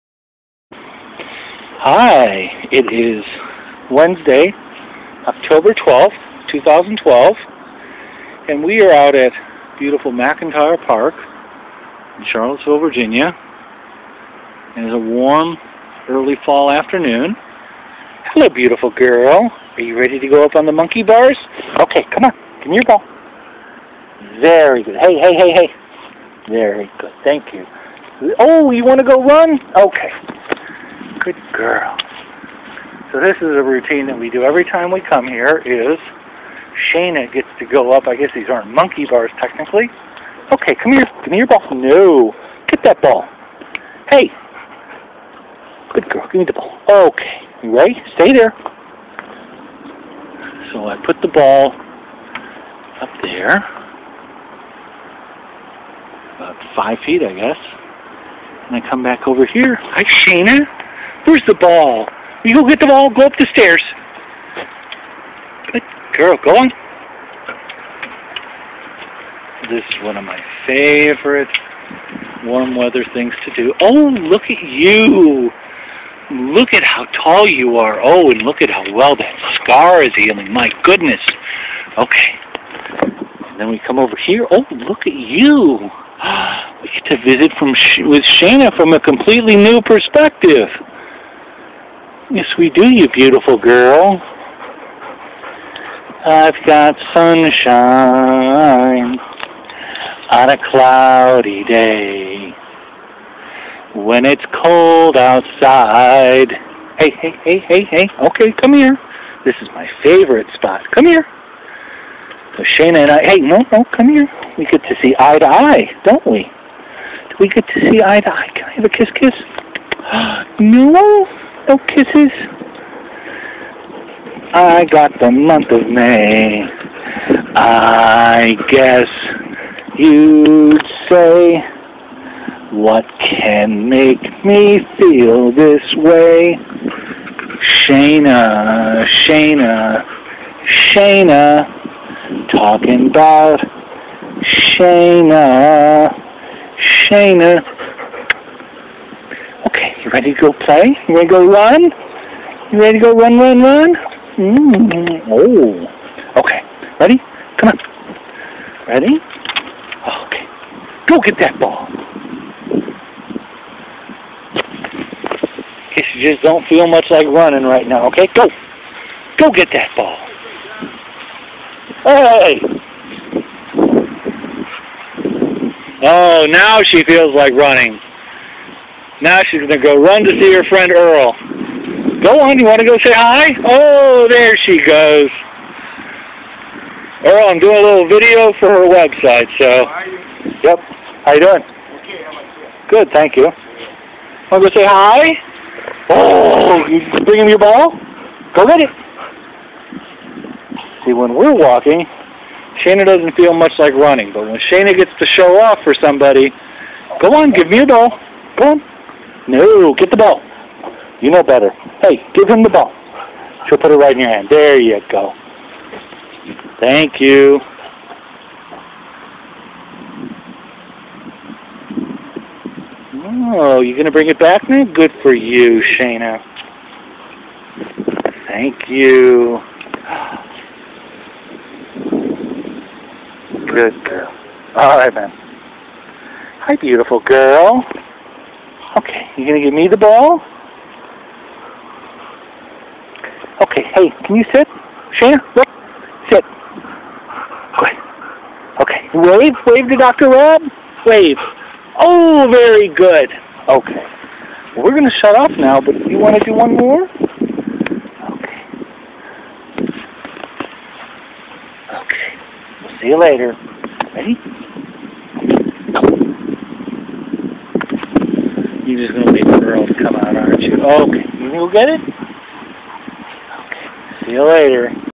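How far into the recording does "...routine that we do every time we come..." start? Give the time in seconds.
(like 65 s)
33 s.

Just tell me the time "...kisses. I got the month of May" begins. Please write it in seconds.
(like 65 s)
121 s.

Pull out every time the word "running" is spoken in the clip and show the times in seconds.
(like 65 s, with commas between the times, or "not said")
167 s, 177 s, 203 s.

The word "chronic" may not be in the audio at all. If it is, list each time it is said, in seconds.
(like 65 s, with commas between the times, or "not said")
not said.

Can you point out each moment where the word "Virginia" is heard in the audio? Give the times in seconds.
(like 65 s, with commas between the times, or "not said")
12 s.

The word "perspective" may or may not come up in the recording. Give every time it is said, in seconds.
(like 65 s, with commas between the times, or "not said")
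89 s.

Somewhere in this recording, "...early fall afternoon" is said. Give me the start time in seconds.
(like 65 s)
16 s.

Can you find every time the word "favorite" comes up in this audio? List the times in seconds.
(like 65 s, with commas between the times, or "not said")
70 s, 110 s.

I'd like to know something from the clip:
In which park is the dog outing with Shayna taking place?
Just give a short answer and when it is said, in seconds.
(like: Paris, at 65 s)
McIntire Park, at 10 s.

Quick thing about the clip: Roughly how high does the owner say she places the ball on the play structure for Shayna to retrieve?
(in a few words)
5 feet.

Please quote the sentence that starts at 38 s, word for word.
I guess these aren't monkey bars technically.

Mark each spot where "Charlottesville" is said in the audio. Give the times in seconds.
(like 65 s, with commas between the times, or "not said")
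12 s.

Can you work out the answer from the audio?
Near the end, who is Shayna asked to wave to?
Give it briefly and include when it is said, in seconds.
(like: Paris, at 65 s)
Dr. Raab, at 249 s.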